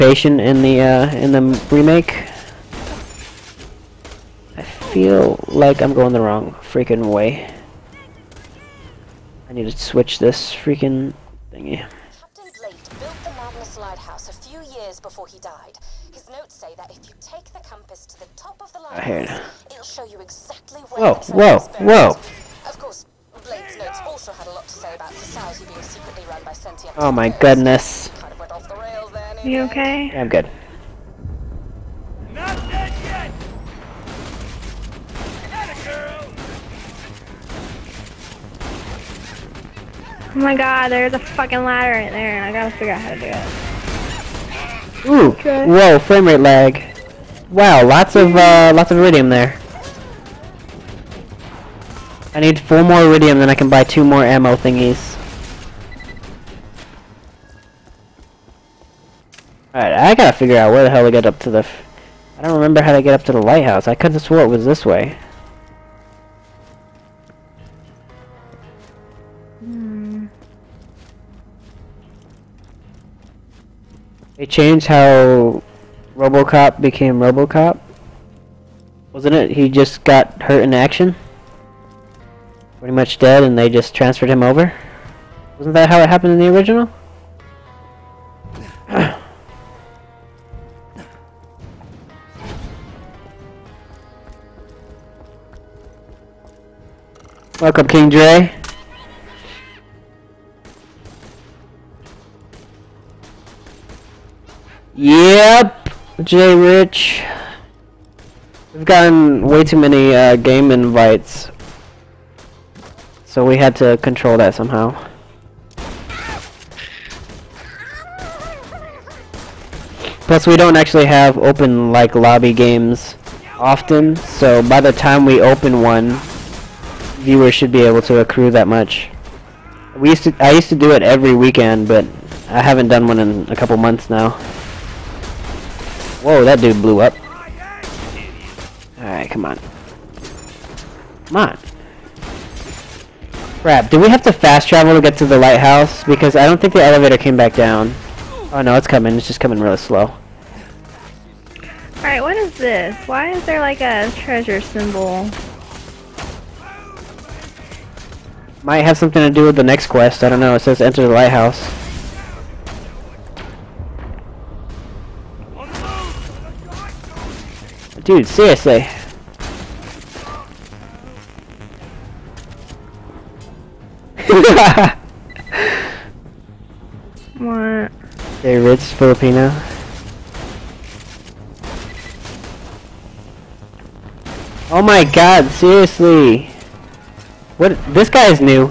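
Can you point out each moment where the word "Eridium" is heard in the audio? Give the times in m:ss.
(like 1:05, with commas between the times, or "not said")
0:48, 0:53.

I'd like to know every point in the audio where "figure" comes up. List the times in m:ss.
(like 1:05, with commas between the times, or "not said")
0:42, 1:00.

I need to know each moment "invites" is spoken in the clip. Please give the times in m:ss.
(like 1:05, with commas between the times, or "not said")
1:50.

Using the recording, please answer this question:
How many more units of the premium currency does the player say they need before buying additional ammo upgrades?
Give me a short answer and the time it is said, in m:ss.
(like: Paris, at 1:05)
4, at 0:52.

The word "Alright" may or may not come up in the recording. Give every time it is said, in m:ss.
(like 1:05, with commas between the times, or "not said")
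0:59, 2:18, 2:31.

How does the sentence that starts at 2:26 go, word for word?
Because I don't think the elevator came back down.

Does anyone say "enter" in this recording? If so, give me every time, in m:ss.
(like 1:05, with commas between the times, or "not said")
2:40.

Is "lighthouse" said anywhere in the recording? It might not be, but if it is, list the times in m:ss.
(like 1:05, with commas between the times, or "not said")
1:03, 2:25, 2:41.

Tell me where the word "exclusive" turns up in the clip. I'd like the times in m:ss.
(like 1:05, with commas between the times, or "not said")
not said.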